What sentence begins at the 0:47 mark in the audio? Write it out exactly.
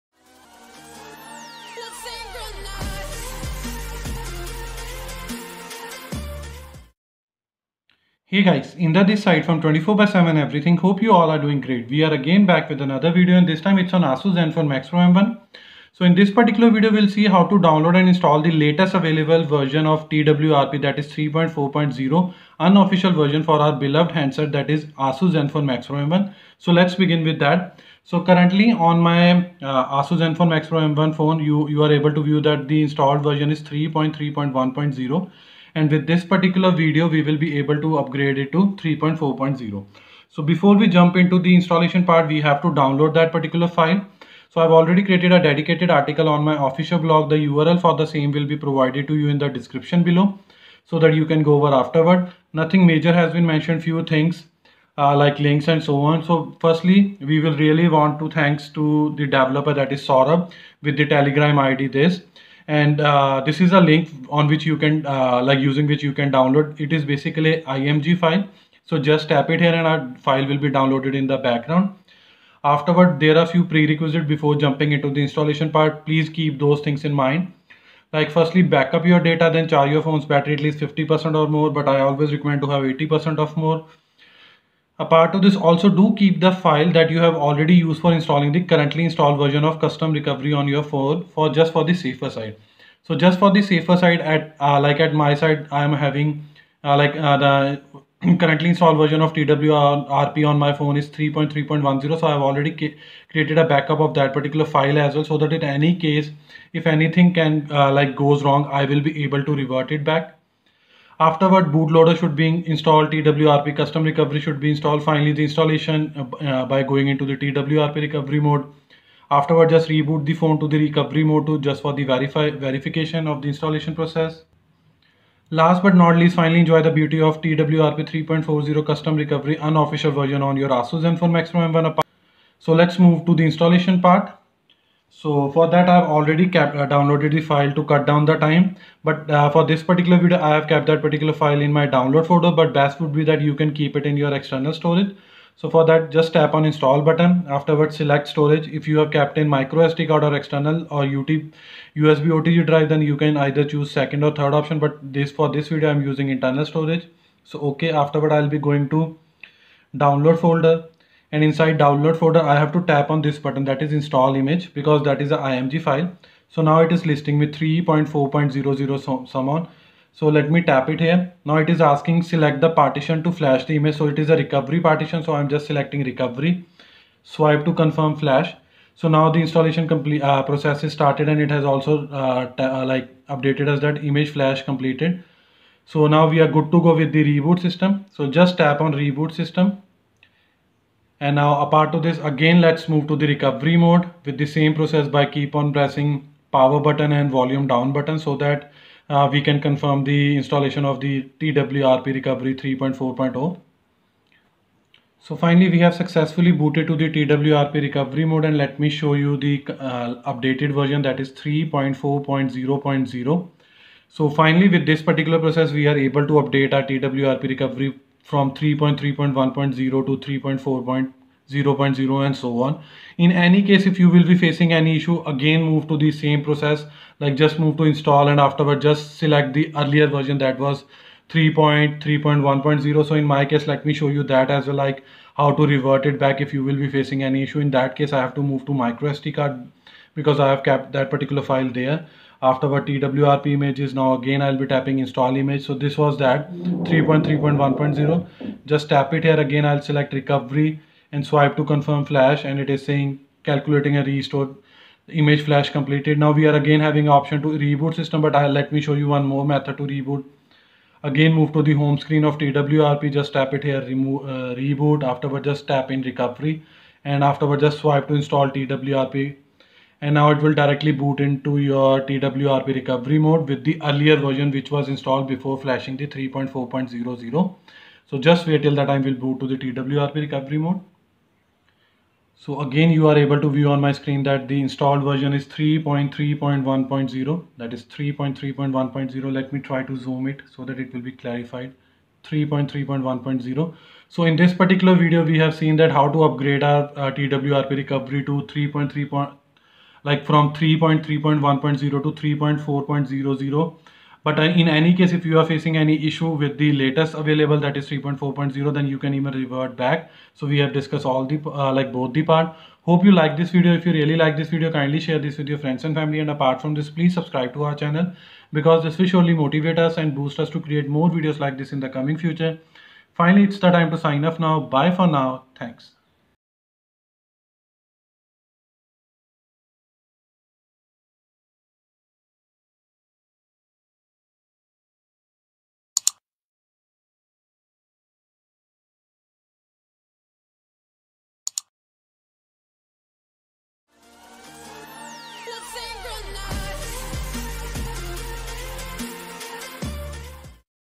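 The URL for the same will be provided to you in the description below so that you can go over afterward.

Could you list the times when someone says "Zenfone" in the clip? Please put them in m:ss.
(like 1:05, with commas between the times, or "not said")
0:14, 0:25, 0:30, 2:11.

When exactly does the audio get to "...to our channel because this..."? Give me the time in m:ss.
5:17.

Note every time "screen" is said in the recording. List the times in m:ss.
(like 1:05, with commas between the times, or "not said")
4:21, 4:43.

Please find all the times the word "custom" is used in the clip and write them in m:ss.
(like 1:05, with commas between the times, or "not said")
1:29, 1:53, 2:08.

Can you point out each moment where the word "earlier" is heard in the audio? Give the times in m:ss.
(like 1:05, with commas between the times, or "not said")
3:49, 4:33.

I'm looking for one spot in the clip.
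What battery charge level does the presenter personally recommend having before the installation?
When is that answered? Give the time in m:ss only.
1:22.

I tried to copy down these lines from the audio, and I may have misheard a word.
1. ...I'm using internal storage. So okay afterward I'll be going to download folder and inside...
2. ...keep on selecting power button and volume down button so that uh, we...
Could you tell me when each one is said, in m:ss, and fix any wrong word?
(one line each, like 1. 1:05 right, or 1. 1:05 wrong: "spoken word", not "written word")
1. 2:35 right
2. 3:15 wrong: "pressing", not "selecting".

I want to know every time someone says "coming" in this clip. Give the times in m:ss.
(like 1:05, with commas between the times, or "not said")
5:21.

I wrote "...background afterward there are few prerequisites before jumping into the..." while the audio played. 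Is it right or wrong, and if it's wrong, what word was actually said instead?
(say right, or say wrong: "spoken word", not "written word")
right.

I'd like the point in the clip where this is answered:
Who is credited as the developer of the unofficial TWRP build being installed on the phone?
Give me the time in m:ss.
1:00.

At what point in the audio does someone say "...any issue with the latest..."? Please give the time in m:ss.
5:05.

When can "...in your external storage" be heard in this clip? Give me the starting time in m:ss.
2:24.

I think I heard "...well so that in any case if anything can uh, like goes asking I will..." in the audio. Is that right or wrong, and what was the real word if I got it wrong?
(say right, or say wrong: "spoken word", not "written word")
wrong: "wrong", not "asking".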